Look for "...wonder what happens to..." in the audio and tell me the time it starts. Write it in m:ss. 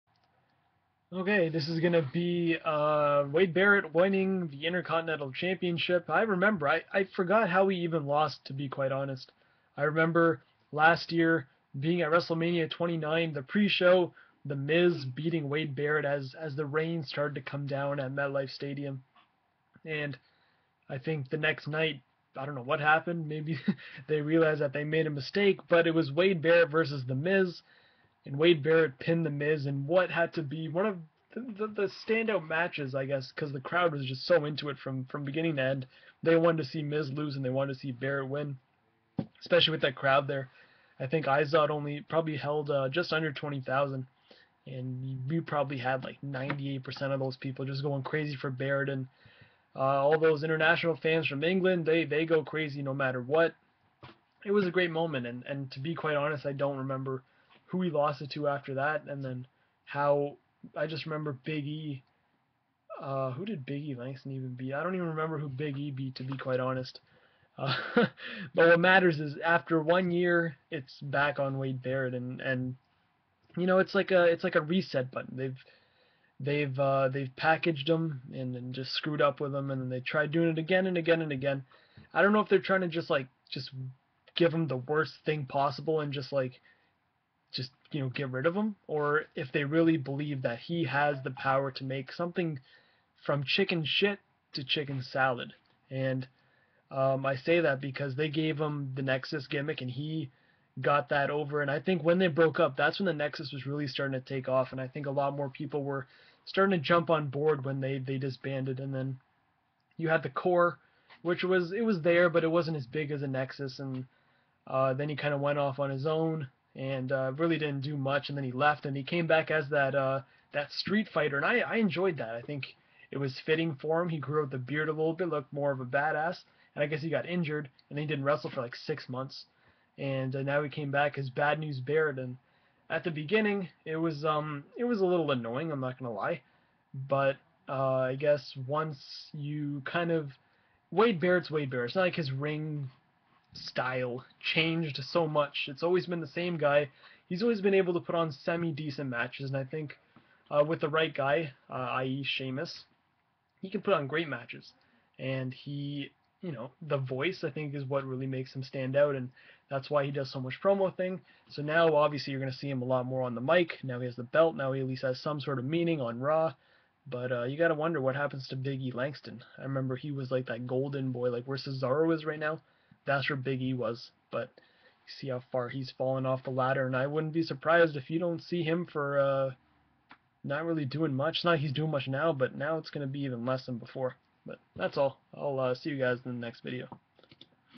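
2:47.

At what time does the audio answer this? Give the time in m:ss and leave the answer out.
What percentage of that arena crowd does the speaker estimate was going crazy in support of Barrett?
0:46.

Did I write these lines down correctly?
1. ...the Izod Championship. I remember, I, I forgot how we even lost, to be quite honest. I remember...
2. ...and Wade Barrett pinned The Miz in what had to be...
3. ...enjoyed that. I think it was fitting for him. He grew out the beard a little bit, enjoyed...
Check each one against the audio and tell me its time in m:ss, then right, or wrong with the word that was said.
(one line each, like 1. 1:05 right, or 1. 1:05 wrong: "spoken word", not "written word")
1. 0:04 wrong: "Intercontinental", not "Izod"
2. 0:28 right
3. 2:01 wrong: "looked", not "enjoyed".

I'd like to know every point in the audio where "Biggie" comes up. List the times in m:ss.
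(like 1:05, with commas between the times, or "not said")
2:48, 2:53.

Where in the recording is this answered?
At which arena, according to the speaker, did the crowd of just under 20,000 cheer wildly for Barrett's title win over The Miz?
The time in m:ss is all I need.
0:41.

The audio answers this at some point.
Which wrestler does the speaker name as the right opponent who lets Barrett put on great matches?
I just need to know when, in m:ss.
2:32.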